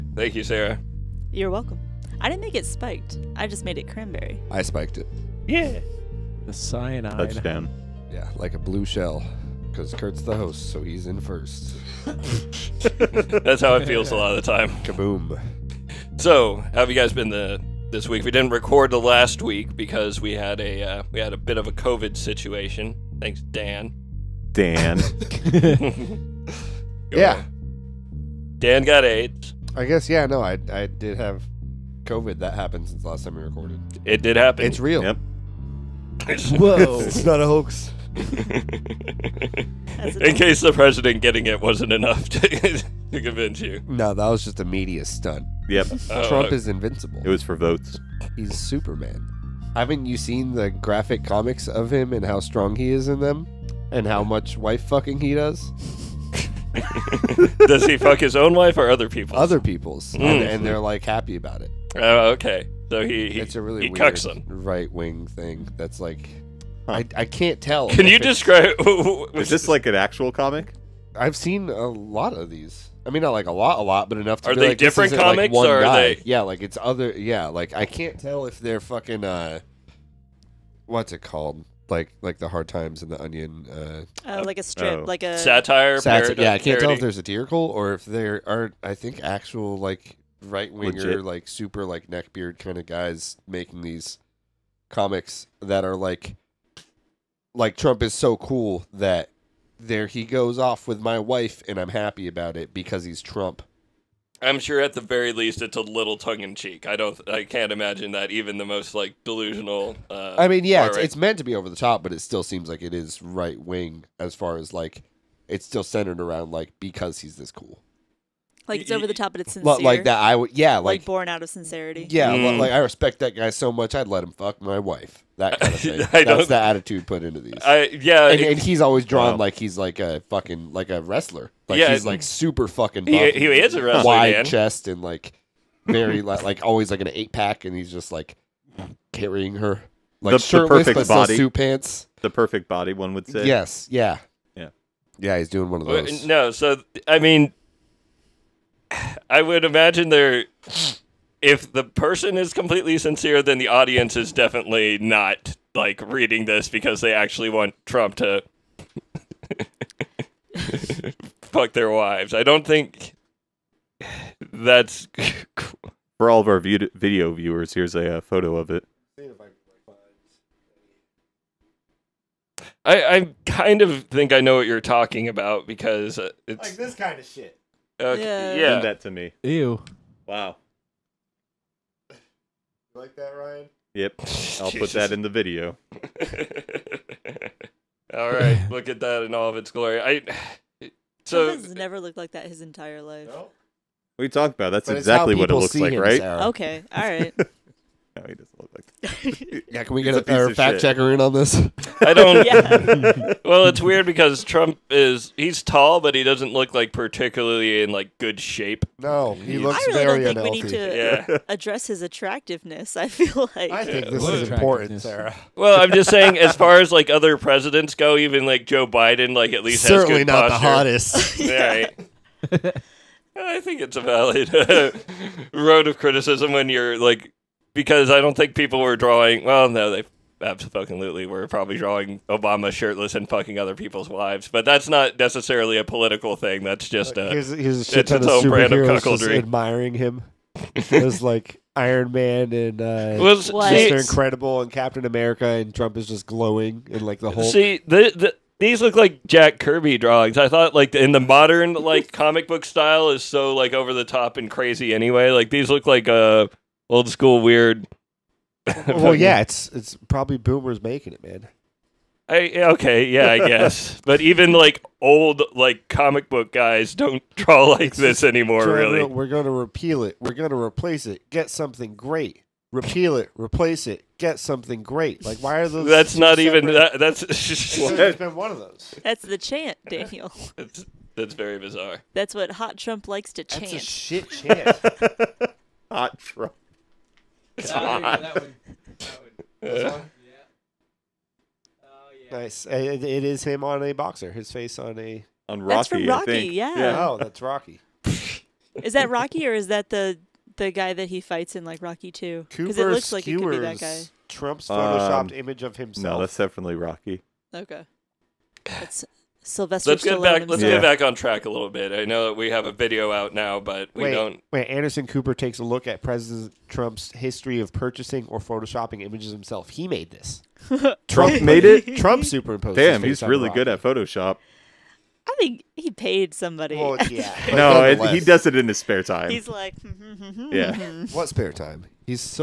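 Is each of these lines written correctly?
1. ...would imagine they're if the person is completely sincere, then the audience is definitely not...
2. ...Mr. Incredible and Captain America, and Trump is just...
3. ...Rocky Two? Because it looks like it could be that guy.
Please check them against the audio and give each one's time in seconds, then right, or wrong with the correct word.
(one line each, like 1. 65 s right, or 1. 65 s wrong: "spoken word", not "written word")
1. 149 s right
2. 243 s right
3. 301 s right.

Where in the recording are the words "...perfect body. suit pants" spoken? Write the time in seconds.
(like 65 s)
140 s.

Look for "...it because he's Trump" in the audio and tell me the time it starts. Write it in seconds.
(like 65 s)
102 s.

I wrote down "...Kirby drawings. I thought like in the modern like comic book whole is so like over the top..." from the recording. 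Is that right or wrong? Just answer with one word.
wrong.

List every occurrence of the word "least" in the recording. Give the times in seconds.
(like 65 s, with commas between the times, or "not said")
105 s, 219 s.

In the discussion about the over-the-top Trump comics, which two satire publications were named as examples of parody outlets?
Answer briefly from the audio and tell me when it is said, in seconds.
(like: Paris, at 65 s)
the Hard Times and the Onion, at 82 s.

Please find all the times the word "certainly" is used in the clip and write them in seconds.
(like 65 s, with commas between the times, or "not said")
219 s.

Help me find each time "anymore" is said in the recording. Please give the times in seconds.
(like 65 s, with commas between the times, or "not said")
268 s.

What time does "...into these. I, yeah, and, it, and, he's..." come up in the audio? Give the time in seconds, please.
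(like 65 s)
127 s.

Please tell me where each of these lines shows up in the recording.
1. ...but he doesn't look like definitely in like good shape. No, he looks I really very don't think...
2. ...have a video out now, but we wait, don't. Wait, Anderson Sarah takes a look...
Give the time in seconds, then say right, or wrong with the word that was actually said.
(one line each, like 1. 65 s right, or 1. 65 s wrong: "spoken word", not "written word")
1. 205 s wrong: "particularly", not "definitely"
2. 312 s wrong: "Cooper", not "Sarah".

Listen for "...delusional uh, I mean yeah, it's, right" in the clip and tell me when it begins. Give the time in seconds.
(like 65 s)
109 s.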